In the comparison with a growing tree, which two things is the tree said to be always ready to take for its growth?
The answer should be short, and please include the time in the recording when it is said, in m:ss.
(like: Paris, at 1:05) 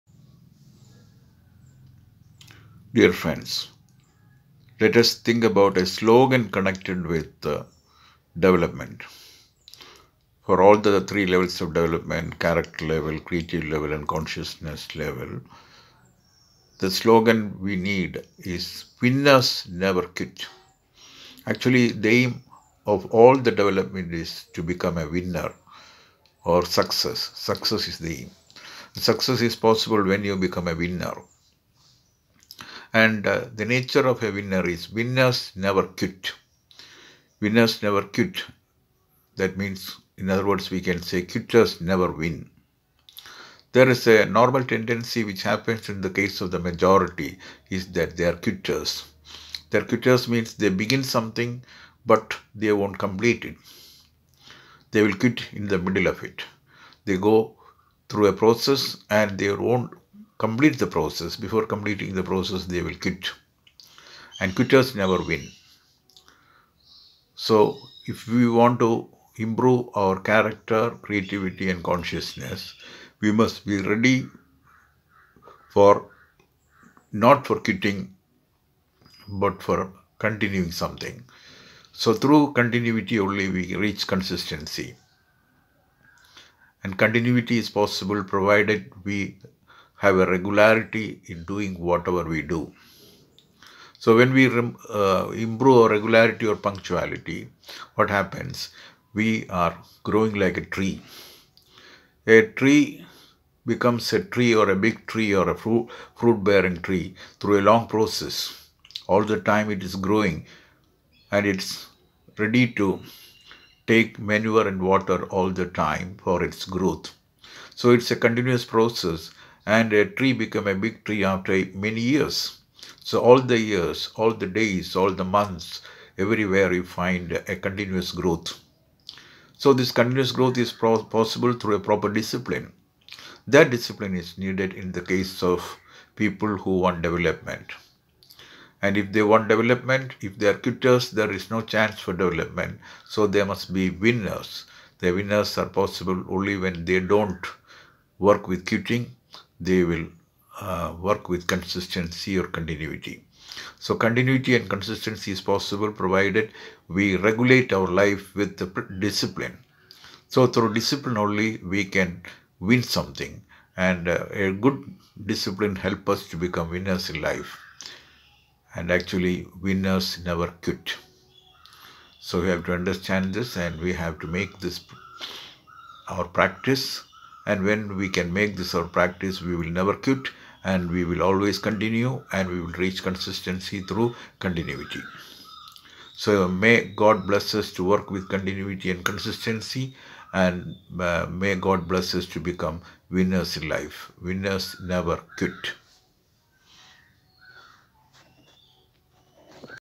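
manure and water, at 1:54.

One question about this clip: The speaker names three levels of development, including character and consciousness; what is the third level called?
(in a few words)
creative level.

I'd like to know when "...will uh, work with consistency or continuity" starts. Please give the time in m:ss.
2:29.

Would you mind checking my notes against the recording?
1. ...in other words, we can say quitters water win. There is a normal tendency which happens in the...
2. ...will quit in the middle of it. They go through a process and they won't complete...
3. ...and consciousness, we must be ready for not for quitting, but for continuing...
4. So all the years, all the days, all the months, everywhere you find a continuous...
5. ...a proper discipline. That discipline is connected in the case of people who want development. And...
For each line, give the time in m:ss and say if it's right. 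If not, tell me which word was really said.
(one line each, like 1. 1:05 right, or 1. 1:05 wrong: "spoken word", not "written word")
1. 0:40 wrong: "never", not "water"
2. 0:55 right
3. 1:11 right
4. 2:03 right
5. 2:11 wrong: "needed", not "connected".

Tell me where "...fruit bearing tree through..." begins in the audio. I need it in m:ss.
1:46.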